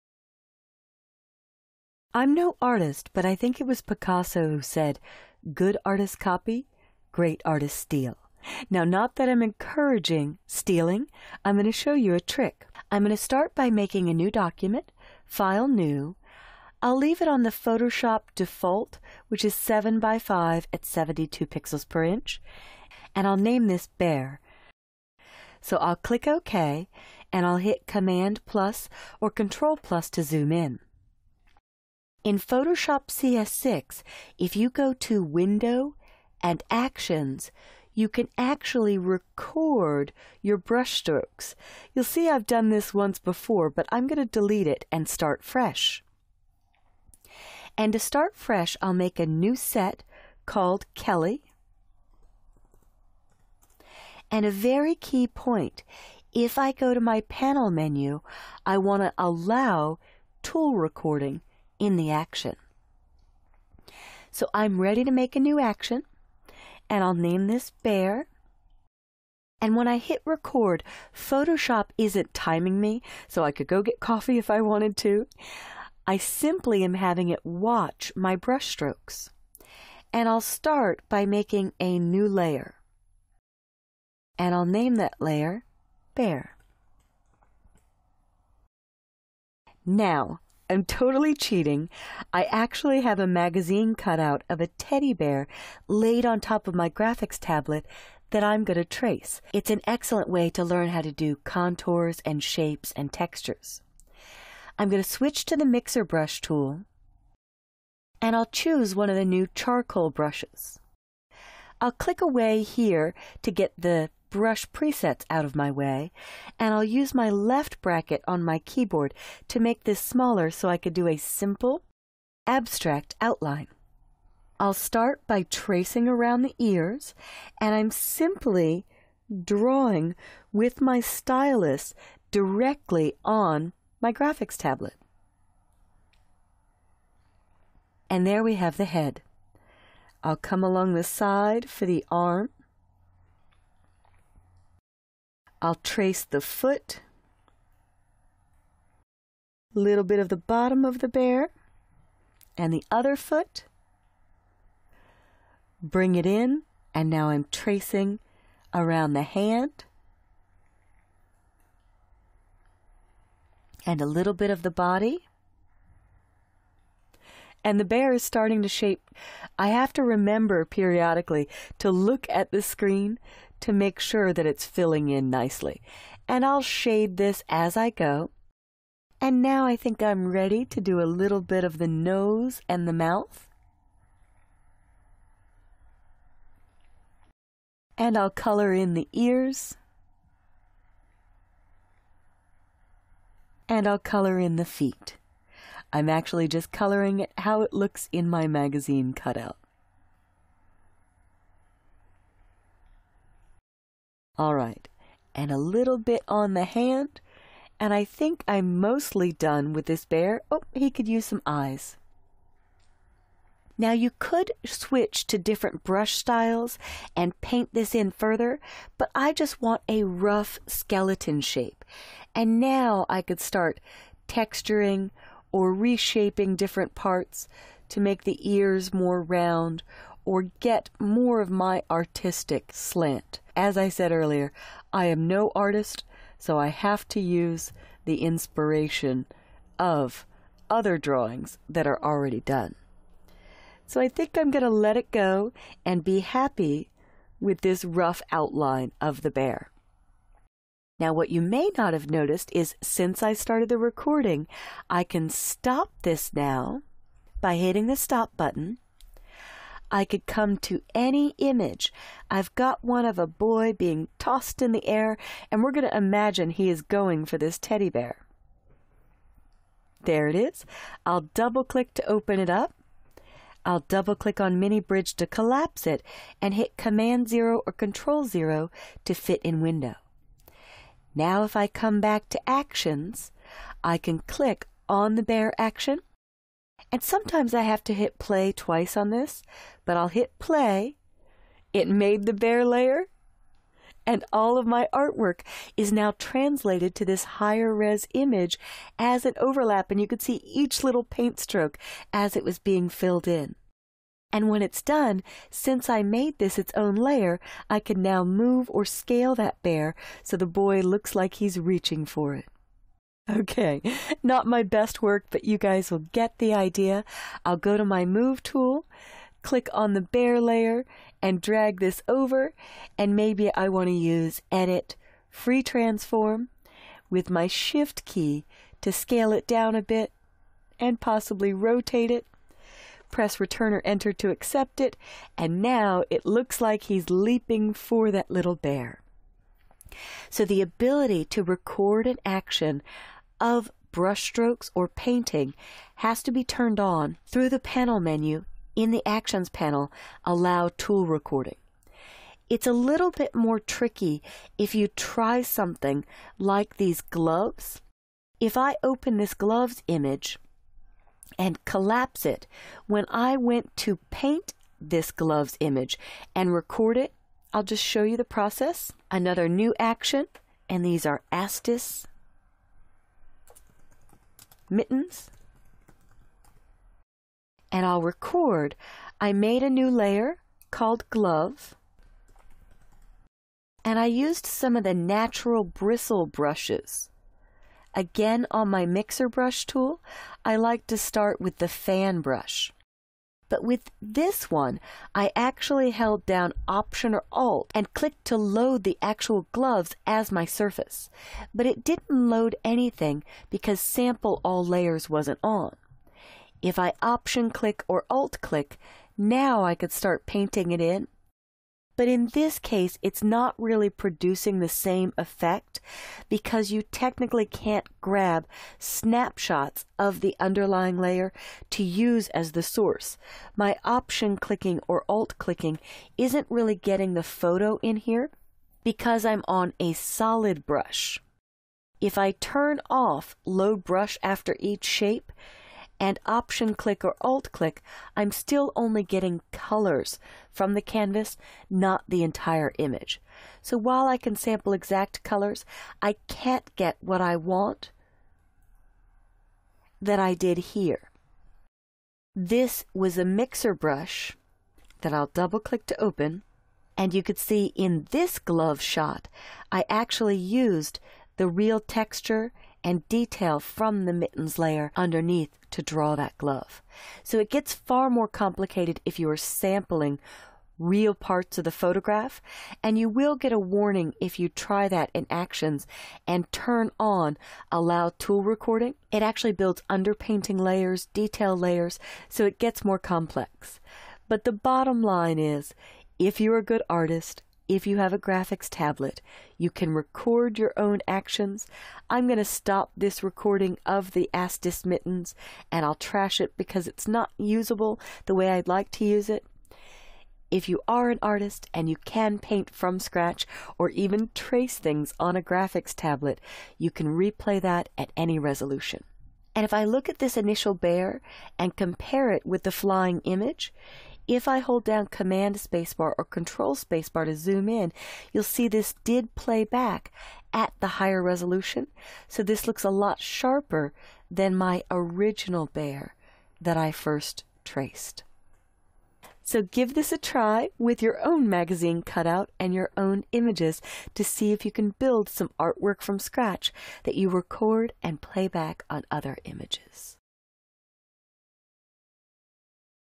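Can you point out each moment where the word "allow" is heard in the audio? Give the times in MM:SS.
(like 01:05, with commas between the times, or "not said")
00:59, 05:50, 07:57.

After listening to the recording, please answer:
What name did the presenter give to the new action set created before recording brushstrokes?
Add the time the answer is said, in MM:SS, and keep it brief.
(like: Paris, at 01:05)
Kelly, at 00:50.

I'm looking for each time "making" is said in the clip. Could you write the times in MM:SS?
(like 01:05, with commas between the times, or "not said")
00:13, 01:21.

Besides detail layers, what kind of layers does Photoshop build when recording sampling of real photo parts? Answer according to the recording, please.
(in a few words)
Underpainting layers.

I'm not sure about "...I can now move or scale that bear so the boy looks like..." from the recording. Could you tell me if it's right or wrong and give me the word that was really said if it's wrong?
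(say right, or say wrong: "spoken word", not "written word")
right.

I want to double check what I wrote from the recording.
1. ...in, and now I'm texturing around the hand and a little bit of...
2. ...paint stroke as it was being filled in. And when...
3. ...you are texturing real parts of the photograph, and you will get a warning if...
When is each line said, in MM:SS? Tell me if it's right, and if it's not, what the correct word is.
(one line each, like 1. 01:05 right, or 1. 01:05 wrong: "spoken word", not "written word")
1. 02:36 wrong: "tracing", not "texturing"
2. 05:01 right
3. 07:49 wrong: "sampling", not "texturing".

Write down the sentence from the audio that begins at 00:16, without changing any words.
I'll leave it on the Photoshop default, which is 7 by 5 at 72 pixels per inch, and I'll name this Bear.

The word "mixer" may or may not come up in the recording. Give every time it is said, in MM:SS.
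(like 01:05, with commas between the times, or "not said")
01:45, 06:28, 07:33.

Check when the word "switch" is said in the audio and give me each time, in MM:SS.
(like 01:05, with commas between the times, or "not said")
01:45, 03:34.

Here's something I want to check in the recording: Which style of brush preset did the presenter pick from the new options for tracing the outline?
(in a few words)
Charcoal.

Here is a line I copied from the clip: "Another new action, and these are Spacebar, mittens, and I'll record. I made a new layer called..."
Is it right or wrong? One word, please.
wrong.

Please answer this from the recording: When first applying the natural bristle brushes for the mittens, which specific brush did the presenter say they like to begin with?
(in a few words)
Fan brush.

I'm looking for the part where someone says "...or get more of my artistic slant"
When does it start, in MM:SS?
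03:50.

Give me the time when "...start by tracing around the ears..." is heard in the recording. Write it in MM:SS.
02:04.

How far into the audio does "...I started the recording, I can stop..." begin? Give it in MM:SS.
04:13.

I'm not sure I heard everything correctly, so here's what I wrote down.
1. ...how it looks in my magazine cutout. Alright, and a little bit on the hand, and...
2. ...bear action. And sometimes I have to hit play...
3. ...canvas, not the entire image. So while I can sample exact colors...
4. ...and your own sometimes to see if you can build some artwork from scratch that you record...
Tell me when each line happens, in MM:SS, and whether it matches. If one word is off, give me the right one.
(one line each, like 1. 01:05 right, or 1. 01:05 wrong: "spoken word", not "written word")
1. 03:17 right
2. 04:45 right
3. 07:20 right
4. 08:52 wrong: "images", not "sometimes".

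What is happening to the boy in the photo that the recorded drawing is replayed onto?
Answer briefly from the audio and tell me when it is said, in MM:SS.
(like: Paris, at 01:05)
Being tossed in the air, at 04:23.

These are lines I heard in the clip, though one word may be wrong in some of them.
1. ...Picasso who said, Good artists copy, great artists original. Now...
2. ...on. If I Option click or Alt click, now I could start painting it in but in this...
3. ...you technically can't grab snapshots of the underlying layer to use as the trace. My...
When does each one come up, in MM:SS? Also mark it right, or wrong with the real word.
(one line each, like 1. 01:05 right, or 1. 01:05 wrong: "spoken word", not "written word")
1. 00:03 wrong: "steal", not "original"
2. 06:45 right
3. 06:56 wrong: "source", not "trace".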